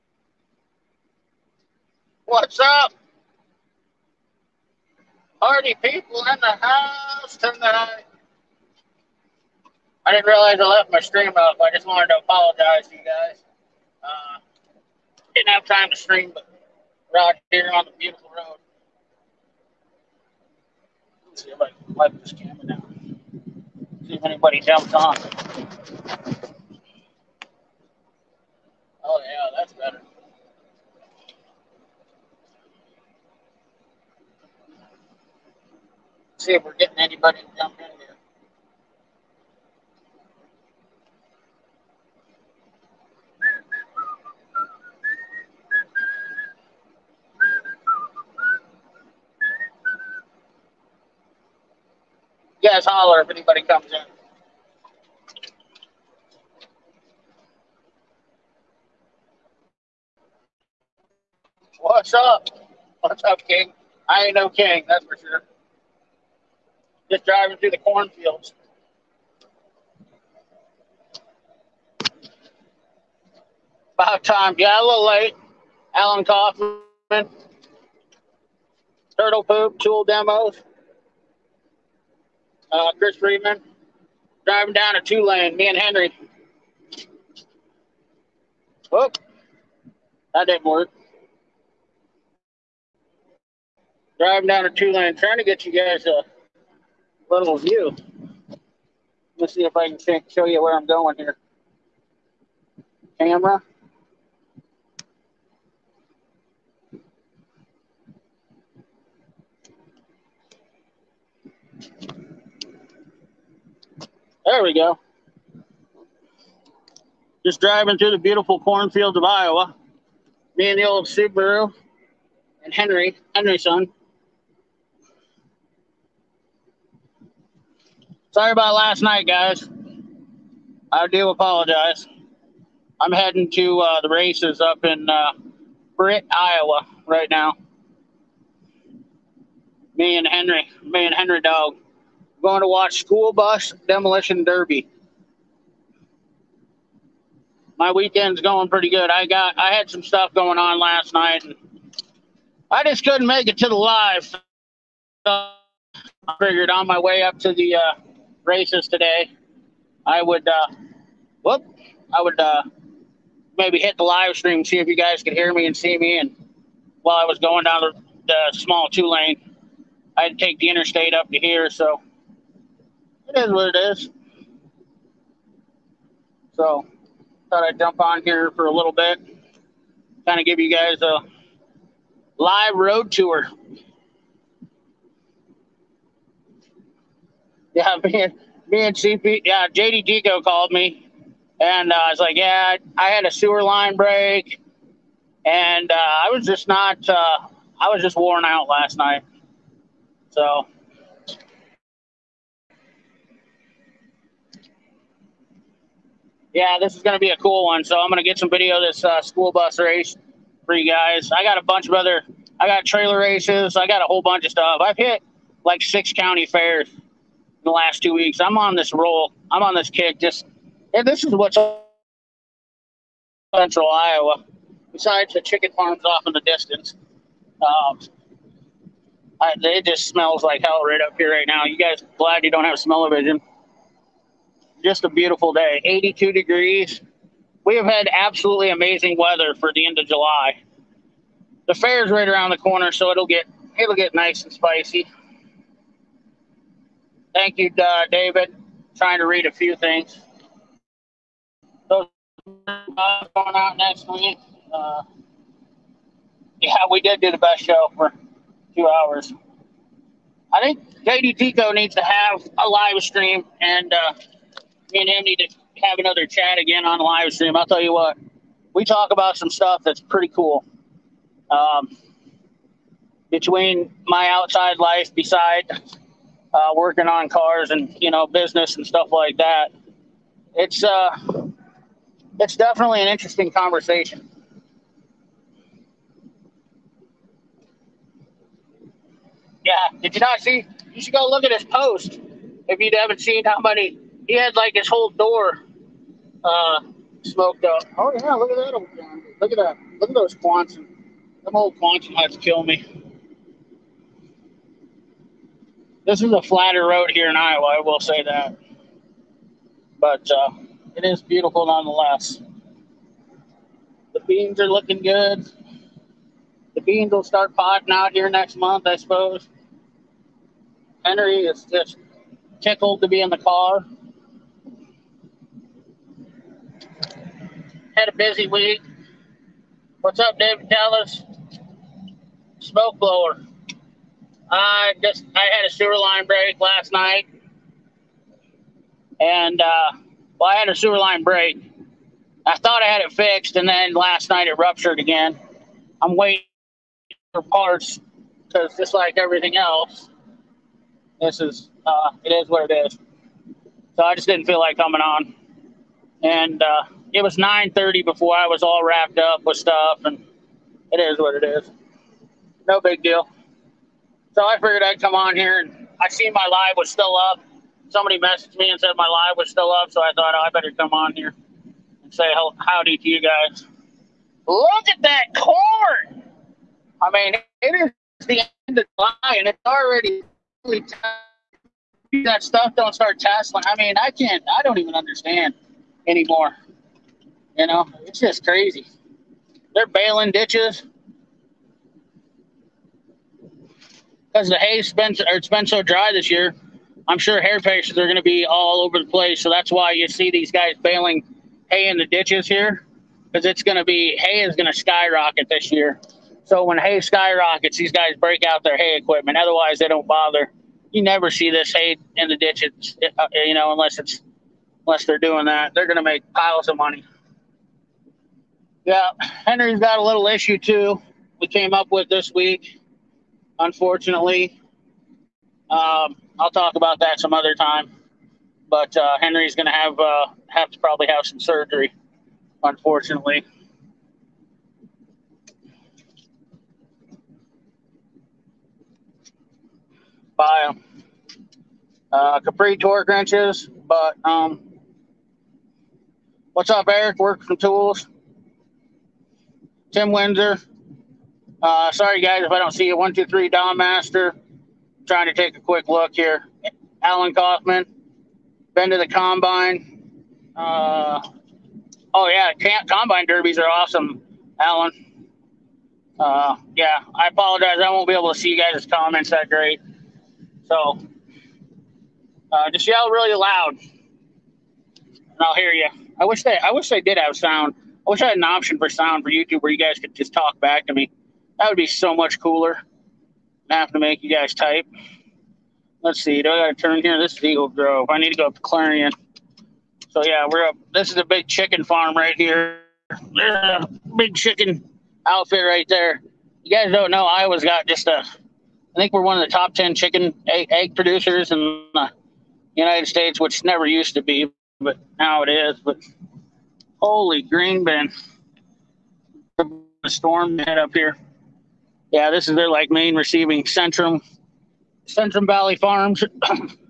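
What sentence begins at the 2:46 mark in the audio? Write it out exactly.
And while I was going down the, the small two lane, I had to take the interstate up to here.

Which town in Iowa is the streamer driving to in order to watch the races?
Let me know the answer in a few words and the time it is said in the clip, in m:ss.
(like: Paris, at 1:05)
Britt, at 2:15.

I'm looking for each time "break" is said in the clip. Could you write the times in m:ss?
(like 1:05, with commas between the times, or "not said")
3:13, 5:36, 5:41, 6:48.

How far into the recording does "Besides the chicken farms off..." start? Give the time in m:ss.
3:44.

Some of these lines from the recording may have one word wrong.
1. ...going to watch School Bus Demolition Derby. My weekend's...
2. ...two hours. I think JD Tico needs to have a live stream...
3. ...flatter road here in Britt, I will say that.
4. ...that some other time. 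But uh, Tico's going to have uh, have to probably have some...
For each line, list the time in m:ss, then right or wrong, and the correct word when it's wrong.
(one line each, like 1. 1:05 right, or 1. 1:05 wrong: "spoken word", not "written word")
1. 2:22 right
2. 4:18 right
3. 5:06 wrong: "Iowa", not "Britt"
4. 7:07 wrong: "Henry", not "Tico".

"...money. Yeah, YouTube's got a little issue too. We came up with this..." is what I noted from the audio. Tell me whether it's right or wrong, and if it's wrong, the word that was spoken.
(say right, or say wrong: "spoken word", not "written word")
wrong: "Henry", not "YouTube".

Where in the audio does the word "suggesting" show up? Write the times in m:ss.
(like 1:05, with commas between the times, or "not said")
not said.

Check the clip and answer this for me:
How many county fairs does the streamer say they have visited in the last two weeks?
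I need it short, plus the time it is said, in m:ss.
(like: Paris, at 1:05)
6, at 3:35.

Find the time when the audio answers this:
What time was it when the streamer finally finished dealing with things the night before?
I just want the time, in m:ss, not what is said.
5:57.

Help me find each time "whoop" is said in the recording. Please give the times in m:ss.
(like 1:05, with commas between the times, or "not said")
1:28, 2:41.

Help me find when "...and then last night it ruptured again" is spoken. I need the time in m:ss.
5:43.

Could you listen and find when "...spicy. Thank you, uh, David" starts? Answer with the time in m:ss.
4:04.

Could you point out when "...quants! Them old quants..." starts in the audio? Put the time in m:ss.
5:00.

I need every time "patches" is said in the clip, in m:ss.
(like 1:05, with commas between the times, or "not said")
6:37.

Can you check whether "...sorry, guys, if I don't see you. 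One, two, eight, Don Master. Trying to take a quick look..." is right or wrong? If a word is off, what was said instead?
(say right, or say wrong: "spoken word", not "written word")
wrong: "three", not "eight".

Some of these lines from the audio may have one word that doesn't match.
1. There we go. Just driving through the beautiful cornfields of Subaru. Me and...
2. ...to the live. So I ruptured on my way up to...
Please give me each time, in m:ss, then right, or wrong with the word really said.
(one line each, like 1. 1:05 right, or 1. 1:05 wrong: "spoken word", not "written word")
1. 1:54 wrong: "Iowa", not "Subaru"
2. 2:33 wrong: "figured", not "ruptured".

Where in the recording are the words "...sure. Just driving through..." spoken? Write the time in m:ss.
1:05.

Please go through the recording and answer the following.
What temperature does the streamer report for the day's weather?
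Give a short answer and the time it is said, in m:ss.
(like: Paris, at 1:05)
82 degrees, at 3:55.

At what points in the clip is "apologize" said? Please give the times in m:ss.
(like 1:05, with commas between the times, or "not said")
0:12, 2:11, 7:47.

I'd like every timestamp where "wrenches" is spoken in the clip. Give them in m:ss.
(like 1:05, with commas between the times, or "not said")
7:23.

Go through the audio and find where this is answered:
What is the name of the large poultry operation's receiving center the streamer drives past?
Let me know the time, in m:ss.
8:35.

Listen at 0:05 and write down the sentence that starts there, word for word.
Party people in the house tonight.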